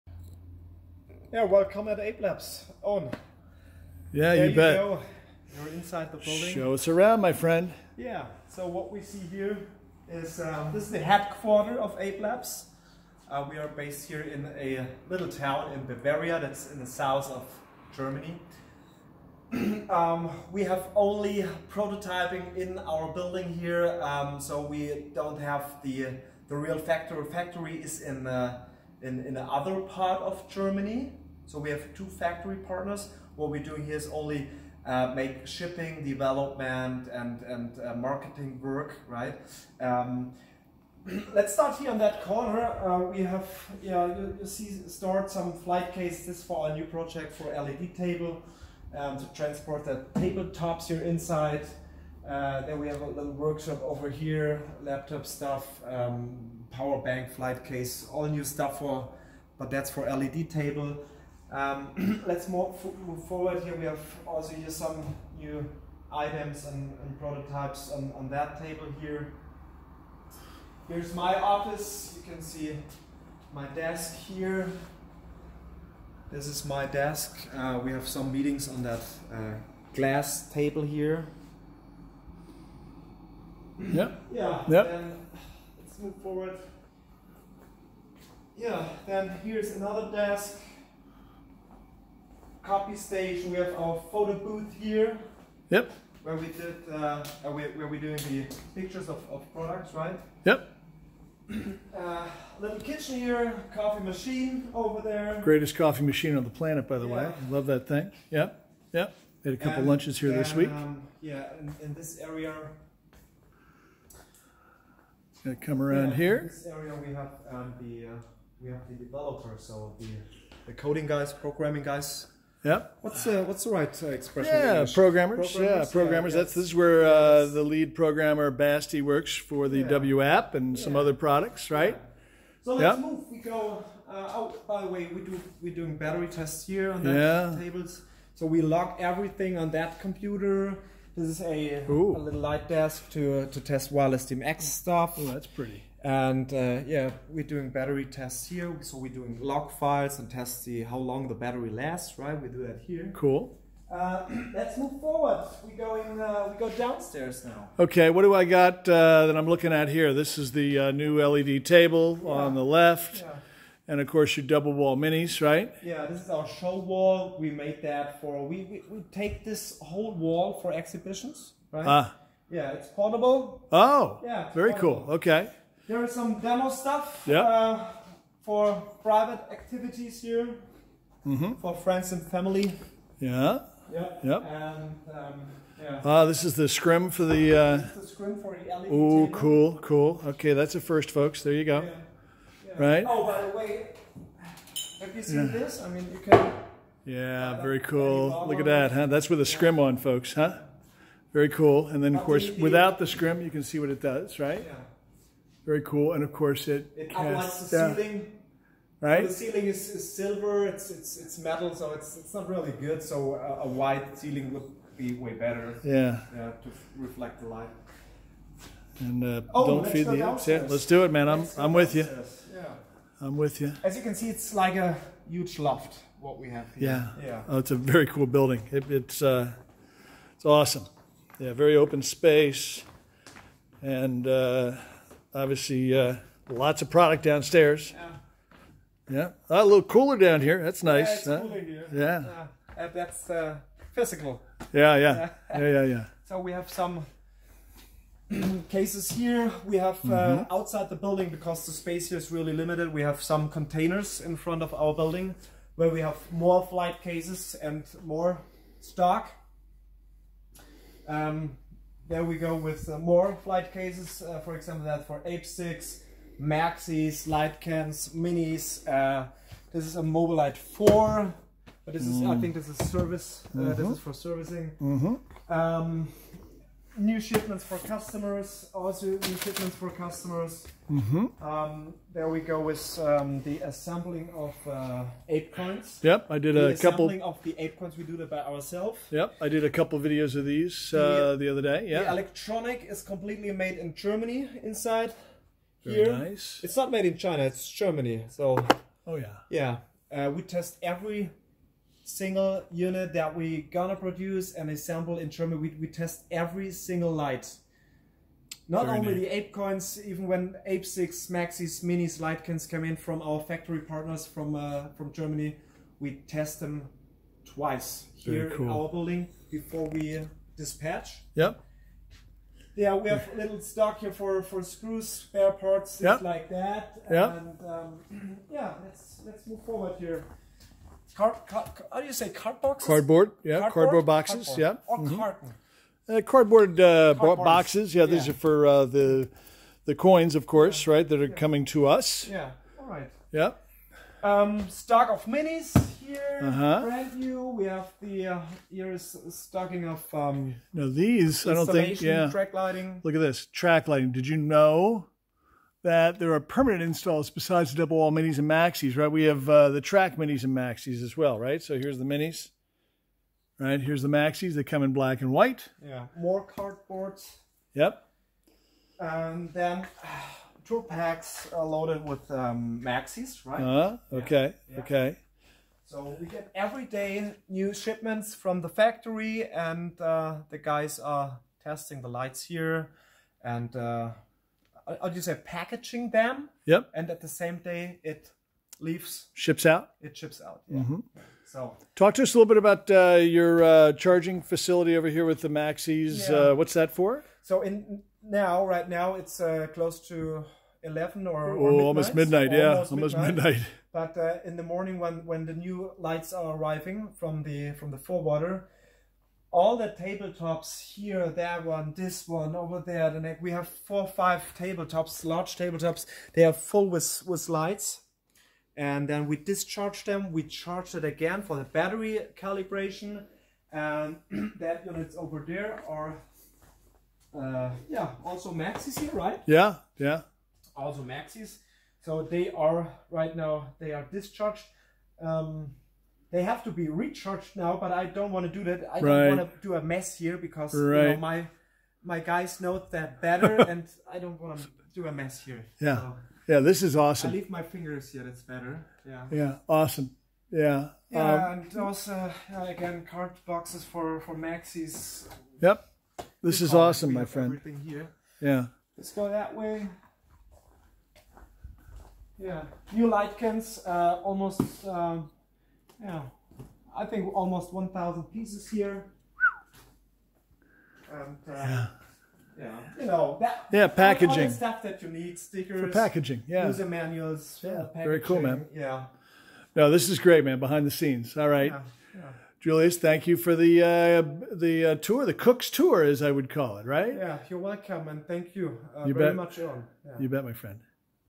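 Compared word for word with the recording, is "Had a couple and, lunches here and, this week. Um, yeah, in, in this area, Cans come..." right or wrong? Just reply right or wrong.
wrong.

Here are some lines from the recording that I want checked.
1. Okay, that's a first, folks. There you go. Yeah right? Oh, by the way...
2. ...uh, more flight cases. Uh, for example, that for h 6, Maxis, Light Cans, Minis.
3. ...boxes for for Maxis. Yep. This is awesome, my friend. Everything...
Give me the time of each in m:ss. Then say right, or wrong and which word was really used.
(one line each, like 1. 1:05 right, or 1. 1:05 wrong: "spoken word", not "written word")
1. 3:10 right
2. 4:22 right
3. 7:33 right.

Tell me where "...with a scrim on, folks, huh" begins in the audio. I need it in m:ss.
3:19.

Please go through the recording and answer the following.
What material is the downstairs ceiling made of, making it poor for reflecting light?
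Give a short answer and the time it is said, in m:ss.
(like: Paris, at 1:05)
metal, at 3:31.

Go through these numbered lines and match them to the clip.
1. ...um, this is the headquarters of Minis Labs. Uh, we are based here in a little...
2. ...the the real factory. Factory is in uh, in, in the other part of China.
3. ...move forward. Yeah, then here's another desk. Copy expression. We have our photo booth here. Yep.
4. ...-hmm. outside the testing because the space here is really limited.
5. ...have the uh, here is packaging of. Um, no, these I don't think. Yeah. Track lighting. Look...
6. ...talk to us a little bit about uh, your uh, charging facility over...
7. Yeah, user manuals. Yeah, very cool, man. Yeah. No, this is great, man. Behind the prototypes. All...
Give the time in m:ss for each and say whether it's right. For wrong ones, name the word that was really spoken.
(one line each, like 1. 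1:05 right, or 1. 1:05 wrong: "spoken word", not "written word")
1. 0:10 wrong: "Ape", not "Minis"
2. 0:25 wrong: "Germany", not "China"
3. 1:26 wrong: "station", not "expression"
4. 4:10 wrong: "building", not "testing"
5. 5:47 wrong: "stocking", not "packaging"
6. 6:31 right
7. 7:56 wrong: "scenes", not "prototypes".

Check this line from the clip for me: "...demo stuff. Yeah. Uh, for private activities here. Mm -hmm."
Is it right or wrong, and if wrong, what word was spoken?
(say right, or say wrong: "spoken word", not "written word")
right.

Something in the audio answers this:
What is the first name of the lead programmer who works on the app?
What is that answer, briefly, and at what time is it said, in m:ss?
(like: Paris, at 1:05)
Basti, at 2:08.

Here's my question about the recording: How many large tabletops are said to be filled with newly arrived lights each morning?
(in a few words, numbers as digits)
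4 or 5.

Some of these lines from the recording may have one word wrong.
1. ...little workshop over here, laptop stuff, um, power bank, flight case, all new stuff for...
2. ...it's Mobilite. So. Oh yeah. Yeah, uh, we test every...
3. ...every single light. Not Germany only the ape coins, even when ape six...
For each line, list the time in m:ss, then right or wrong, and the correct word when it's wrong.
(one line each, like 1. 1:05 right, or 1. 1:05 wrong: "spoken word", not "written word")
1. 0:53 right
2. 4:57 wrong: "Germany", not "Mobilite"
3. 5:06 wrong: "Very", not "Germany".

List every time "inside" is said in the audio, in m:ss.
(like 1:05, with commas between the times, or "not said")
0:05, 0:51, 4:54.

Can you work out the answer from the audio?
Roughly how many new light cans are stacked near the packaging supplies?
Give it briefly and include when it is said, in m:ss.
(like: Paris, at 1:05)
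1,000, at 7:47.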